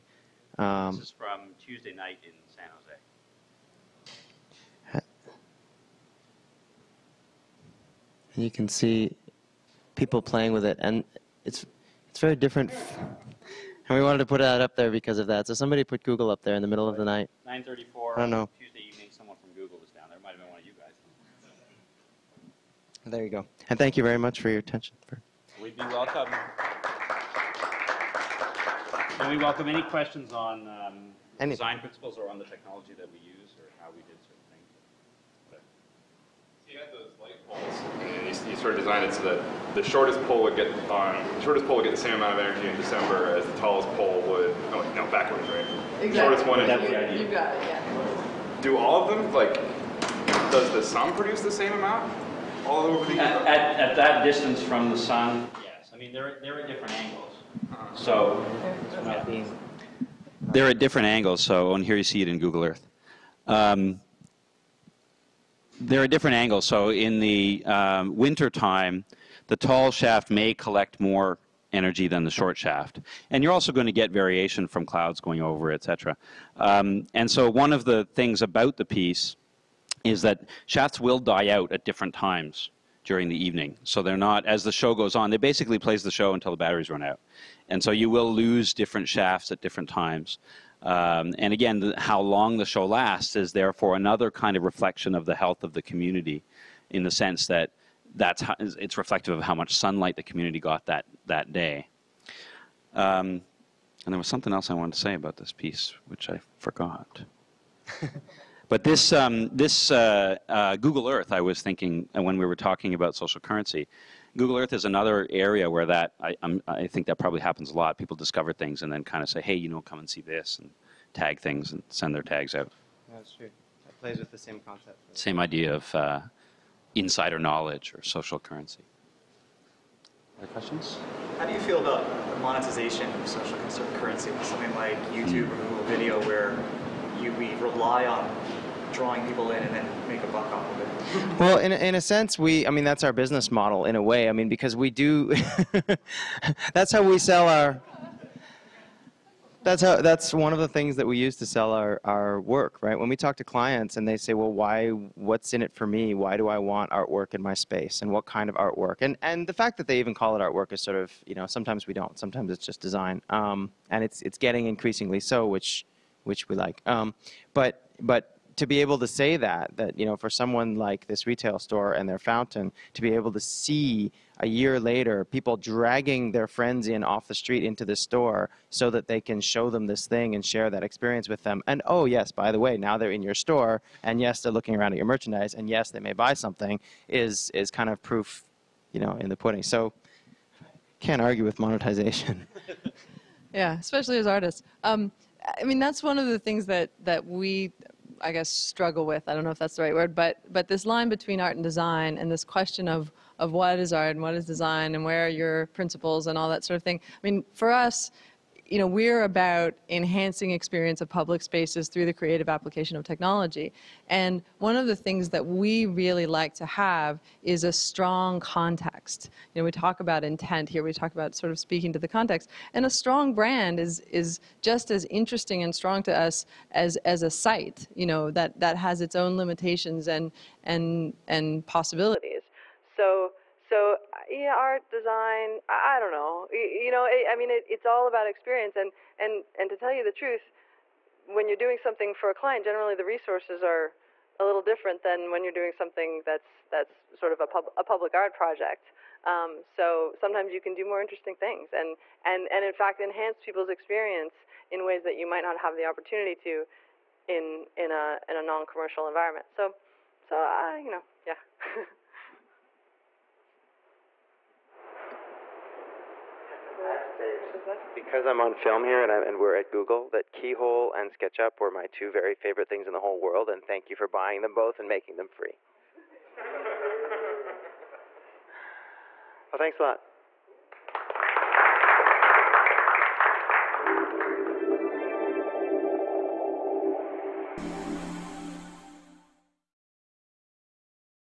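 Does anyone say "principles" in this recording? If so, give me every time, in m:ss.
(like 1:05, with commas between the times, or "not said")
0:31, 3:25.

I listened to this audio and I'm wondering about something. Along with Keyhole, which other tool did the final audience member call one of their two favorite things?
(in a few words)
SketchUp.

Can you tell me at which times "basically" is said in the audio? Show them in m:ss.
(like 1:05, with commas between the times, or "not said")
1:25.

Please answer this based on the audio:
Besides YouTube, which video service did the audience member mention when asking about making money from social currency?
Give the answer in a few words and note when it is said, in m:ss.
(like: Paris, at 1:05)
Google Video, at 2:15.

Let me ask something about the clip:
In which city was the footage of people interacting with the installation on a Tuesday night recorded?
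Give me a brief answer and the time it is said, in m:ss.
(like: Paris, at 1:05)
San Jose, at 0:02.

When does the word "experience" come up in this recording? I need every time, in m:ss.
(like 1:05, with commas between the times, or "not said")
3:00, 3:30, 3:58, 4:13.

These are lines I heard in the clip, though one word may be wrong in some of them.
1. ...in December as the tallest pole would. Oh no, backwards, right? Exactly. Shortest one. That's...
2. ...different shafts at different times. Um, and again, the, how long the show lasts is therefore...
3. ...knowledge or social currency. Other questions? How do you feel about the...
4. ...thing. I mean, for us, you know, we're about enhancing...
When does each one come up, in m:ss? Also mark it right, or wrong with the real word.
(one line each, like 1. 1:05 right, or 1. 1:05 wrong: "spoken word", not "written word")
1. 0:42 right
2. 1:28 right
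3. 2:07 right
4. 3:26 right.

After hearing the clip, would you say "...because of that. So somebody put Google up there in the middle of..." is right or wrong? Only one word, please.
right.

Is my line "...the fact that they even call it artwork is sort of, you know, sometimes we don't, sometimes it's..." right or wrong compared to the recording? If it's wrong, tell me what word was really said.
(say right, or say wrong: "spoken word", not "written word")
right.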